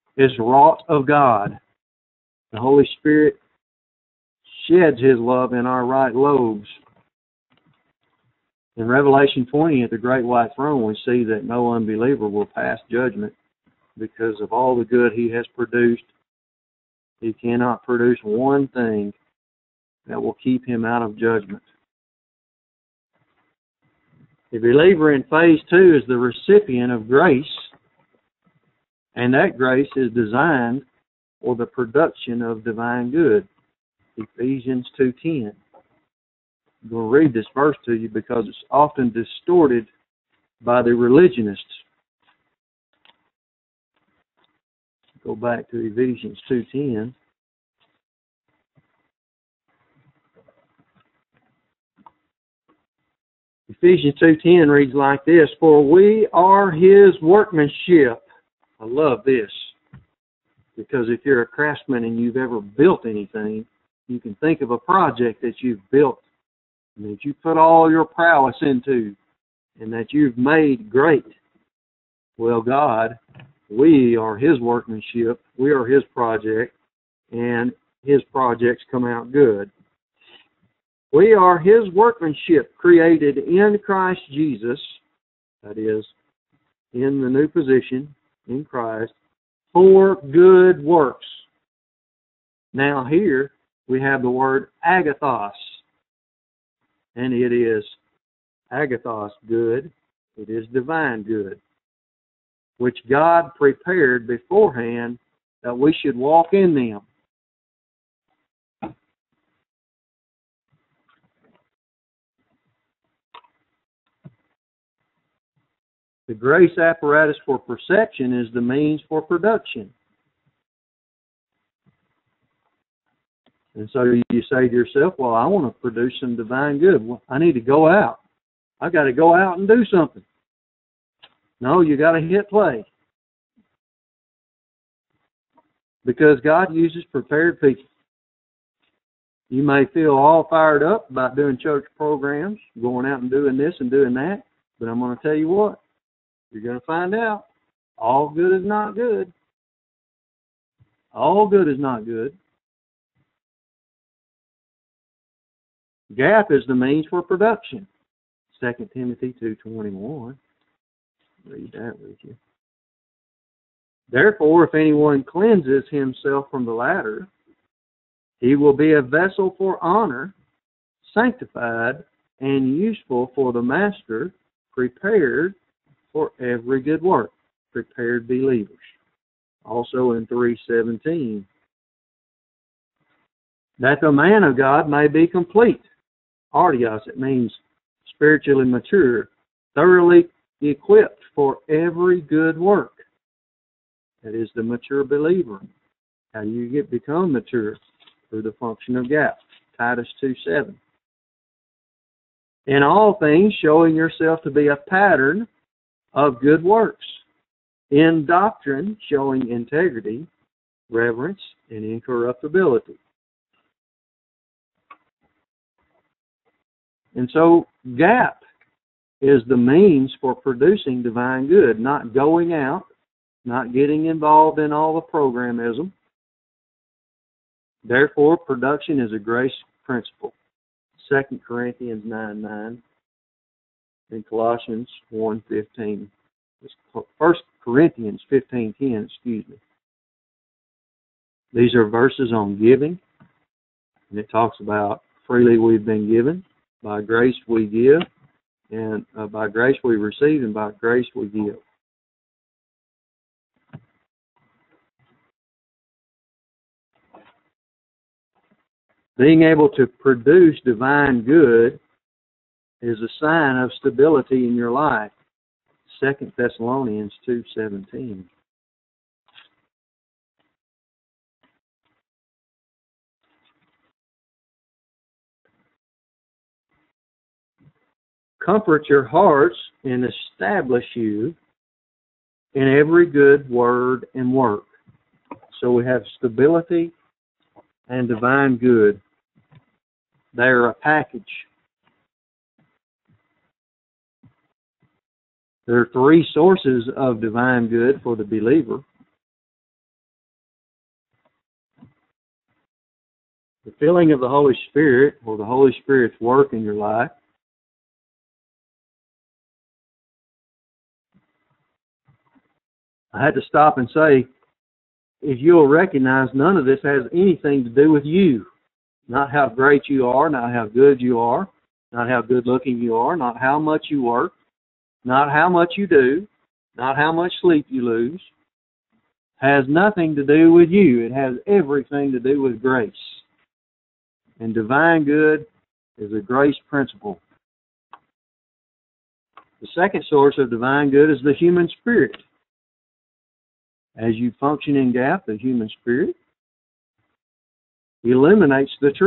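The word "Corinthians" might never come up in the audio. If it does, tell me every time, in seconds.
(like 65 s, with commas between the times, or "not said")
231 s, 237 s.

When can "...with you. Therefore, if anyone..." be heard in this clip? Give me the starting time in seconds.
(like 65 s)
161 s.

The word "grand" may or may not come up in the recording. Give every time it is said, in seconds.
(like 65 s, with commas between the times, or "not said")
not said.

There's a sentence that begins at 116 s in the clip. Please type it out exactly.
The grace apparatus for perception is the means for production.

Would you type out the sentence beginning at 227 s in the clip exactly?
Therefore, production is a grace principle.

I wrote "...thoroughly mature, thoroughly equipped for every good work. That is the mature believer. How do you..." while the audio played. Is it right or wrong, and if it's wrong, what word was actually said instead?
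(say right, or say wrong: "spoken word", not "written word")
wrong: "spiritually", not "thoroughly".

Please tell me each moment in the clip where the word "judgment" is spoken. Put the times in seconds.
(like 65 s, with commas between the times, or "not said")
12 s, 21 s.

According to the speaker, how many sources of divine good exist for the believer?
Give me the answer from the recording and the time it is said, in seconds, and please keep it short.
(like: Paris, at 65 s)
3, at 295 s.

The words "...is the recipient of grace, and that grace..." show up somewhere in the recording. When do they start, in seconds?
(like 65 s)
26 s.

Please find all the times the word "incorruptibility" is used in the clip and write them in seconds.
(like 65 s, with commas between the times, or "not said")
211 s.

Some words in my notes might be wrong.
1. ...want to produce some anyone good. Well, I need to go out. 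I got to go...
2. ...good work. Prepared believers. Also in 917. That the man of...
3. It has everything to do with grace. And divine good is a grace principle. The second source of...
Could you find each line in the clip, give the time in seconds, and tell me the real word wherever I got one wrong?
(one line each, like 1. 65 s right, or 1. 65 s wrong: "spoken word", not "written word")
1. 125 s wrong: "divine", not "anyone"
2. 176 s wrong: "317", not "917"
3. 331 s right.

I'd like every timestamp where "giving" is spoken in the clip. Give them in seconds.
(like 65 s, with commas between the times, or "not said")
242 s.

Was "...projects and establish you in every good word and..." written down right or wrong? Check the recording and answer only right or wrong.
wrong.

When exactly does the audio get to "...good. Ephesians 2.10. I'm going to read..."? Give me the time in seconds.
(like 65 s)
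33 s.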